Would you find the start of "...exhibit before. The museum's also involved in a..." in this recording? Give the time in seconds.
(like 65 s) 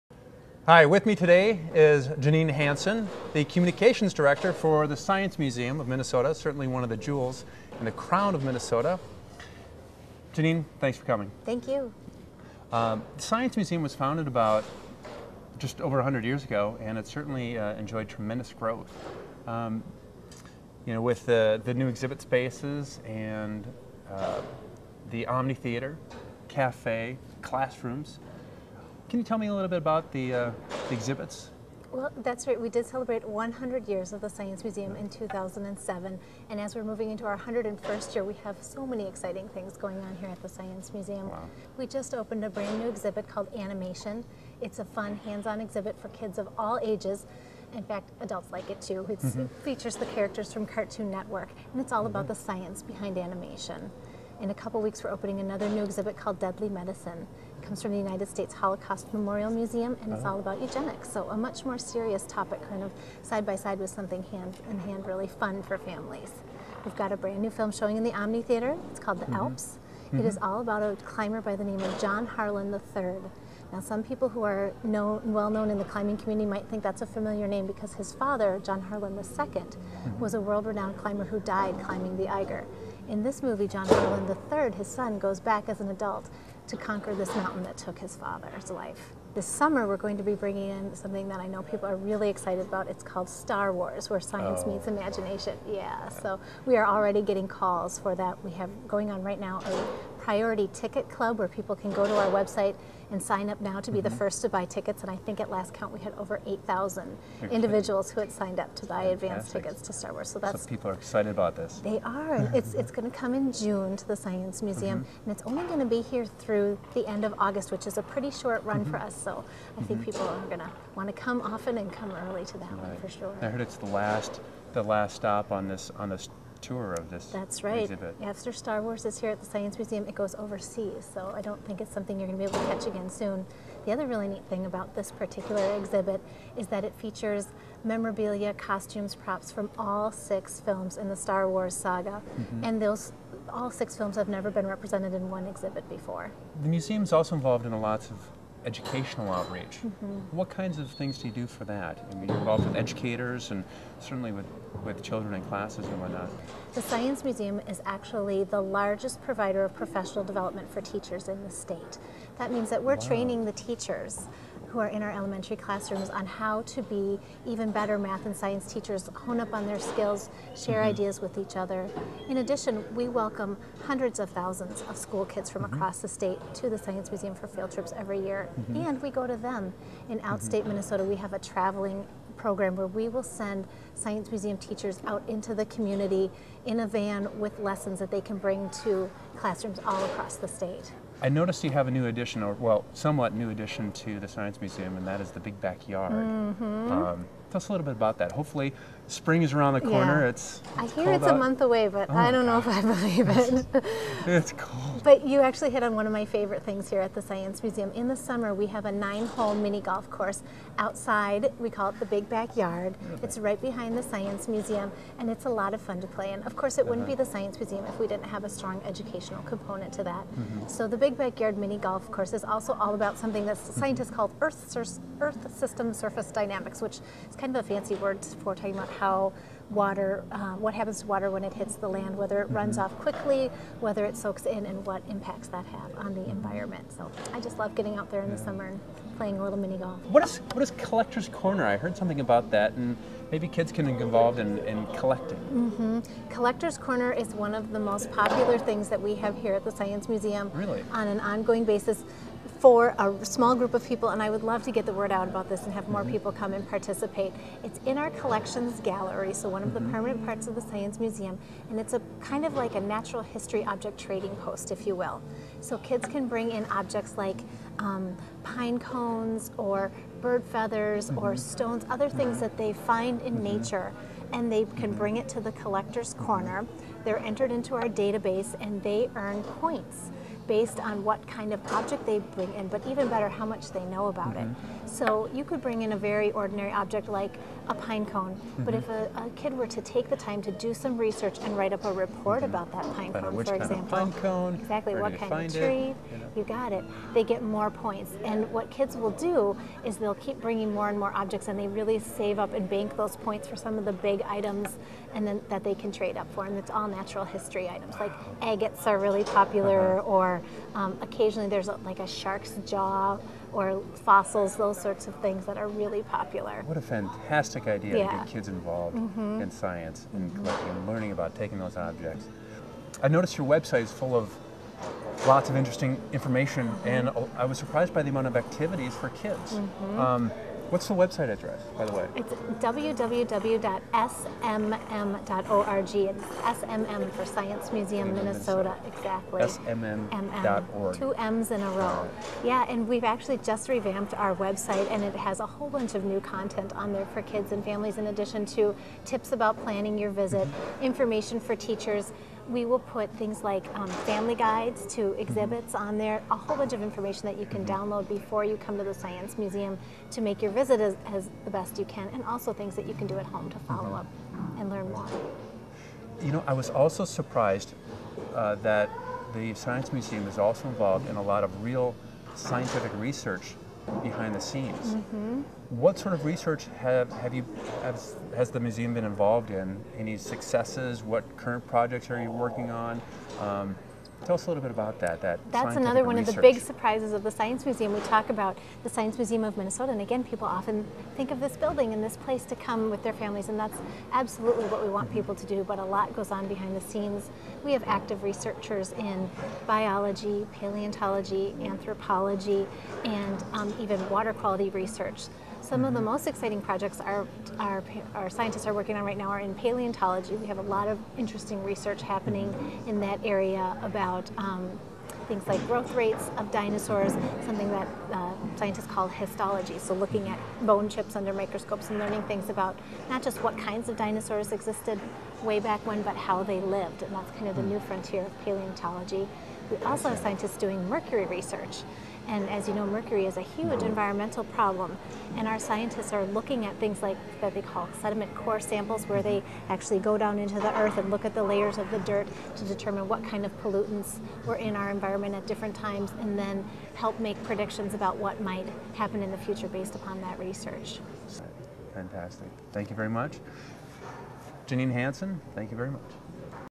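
145 s.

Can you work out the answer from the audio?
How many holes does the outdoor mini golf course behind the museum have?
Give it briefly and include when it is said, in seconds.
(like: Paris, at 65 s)
9, at 208 s.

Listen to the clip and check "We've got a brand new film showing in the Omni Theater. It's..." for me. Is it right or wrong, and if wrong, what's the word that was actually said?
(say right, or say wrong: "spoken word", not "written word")
right.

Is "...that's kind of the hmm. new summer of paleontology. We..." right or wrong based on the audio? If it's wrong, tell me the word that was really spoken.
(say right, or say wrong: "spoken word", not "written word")
wrong: "frontier", not "summer".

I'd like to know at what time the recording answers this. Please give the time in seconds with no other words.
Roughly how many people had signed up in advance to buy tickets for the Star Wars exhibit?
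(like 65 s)
106 s.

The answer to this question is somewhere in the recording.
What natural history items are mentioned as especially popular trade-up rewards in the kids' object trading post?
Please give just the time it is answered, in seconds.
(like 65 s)
308 s.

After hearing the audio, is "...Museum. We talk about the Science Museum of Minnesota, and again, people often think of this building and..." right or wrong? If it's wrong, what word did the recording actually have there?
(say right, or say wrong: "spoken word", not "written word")
right.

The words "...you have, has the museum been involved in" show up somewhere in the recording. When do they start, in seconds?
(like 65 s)
377 s.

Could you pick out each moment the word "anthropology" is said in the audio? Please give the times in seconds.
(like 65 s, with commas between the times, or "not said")
401 s.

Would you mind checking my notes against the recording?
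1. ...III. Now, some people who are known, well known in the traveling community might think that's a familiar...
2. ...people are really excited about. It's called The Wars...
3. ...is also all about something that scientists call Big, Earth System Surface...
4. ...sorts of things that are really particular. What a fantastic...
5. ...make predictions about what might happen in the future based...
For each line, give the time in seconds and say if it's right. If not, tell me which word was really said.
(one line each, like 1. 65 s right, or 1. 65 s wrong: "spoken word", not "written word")
1. 72 s wrong: "climbing", not "traveling"
2. 91 s wrong: "Star", not "The"
3. 222 s wrong: "Earth", not "Big"
4. 314 s wrong: "popular", not "particular"
5. 447 s right.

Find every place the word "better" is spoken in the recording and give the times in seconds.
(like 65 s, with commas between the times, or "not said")
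167 s, 283 s.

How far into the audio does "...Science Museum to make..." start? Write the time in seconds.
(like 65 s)
358 s.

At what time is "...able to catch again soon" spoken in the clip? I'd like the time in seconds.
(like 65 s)
132 s.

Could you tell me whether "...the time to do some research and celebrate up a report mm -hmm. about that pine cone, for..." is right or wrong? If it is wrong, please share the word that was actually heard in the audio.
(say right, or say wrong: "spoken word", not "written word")
wrong: "write", not "celebrate".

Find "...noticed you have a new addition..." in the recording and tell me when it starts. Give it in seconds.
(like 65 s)
191 s.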